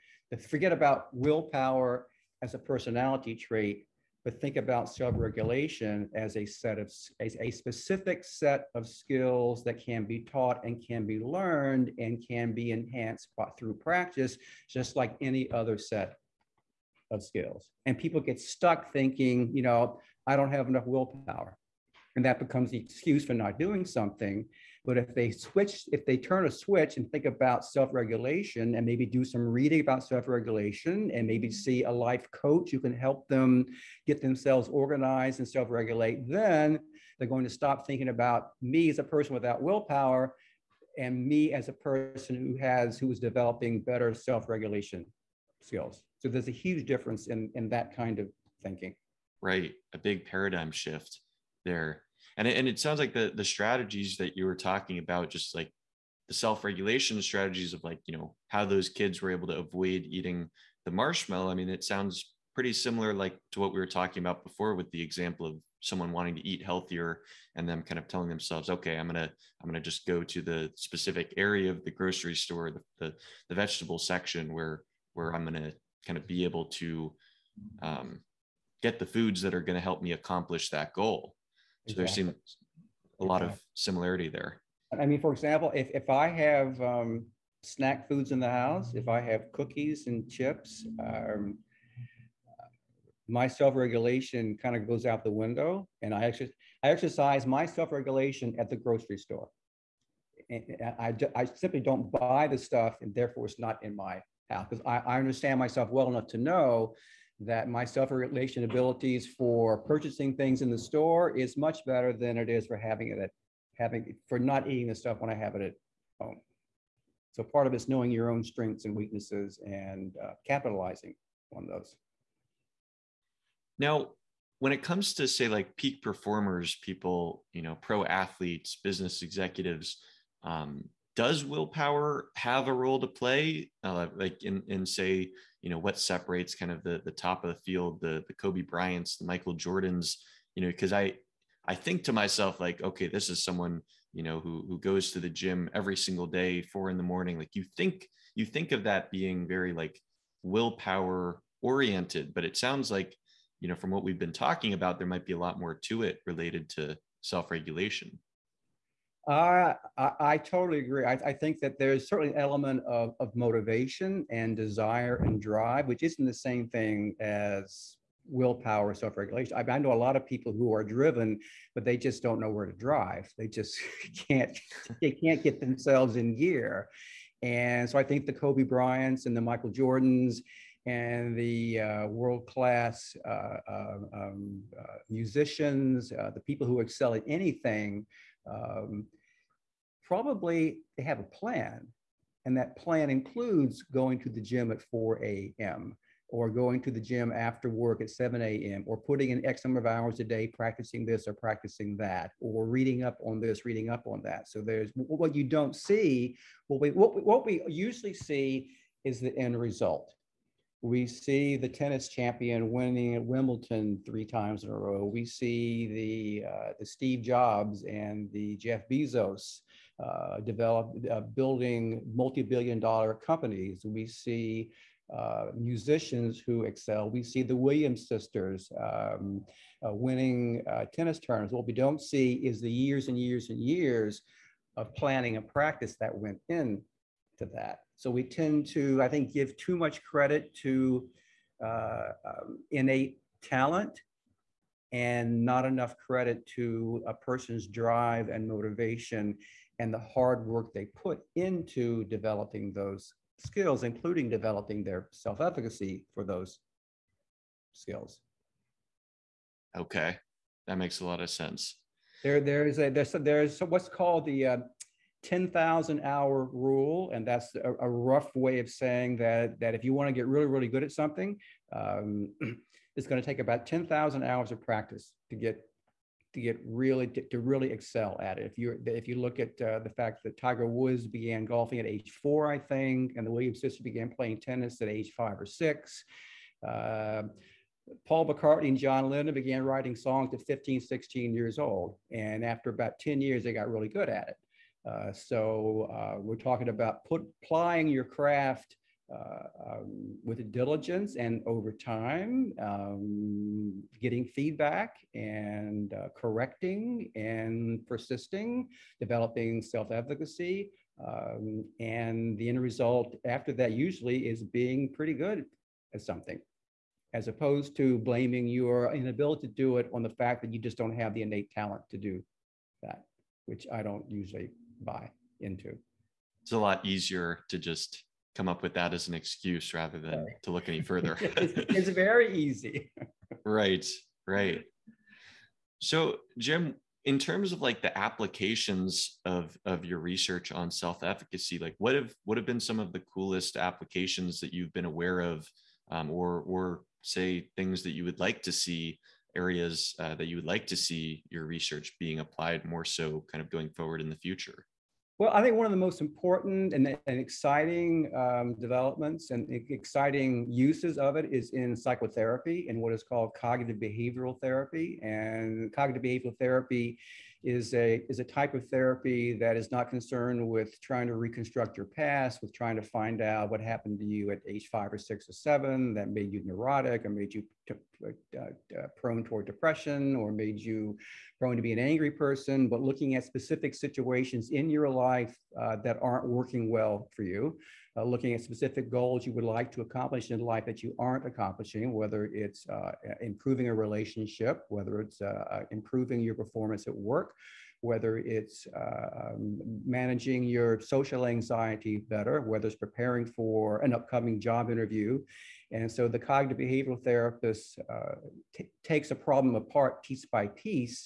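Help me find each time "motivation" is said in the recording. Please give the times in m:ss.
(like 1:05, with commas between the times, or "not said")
2:43, 4:08.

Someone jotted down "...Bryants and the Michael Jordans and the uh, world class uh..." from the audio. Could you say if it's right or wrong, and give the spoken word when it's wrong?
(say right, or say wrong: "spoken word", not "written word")
right.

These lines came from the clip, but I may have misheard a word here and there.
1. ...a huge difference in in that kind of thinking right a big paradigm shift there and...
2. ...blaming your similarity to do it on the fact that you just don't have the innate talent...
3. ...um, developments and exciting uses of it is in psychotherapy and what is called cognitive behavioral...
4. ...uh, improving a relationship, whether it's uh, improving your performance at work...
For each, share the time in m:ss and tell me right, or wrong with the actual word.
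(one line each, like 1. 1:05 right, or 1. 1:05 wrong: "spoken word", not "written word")
1. 0:46 right
2. 5:17 wrong: "inability", not "similarity"
3. 5:58 right
4. 6:32 right.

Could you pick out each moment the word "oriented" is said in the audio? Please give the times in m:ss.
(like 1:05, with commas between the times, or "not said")
2:31.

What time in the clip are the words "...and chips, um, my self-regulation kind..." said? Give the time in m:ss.
1:30.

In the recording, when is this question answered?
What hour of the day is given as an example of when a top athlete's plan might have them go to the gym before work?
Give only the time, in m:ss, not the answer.
3:14.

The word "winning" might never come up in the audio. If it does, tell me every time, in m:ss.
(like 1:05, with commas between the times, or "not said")
3:32, 3:49.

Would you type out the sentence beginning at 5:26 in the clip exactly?
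It's a lot easier to just come up with that as an excuse rather than right.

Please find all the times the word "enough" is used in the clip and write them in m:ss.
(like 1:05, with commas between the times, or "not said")
0:20, 1:46, 4:05.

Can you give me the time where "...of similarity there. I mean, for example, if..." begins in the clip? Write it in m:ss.
1:23.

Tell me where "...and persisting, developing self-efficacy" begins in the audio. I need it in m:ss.
5:07.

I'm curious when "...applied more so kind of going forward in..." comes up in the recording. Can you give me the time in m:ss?
5:52.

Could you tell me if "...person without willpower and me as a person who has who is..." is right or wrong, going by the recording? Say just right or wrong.
right.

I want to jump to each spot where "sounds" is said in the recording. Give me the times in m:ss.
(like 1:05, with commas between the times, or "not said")
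0:52, 1:01, 2:32.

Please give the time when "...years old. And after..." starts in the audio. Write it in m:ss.
4:51.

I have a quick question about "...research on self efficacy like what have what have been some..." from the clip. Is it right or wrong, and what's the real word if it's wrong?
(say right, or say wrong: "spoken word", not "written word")
right.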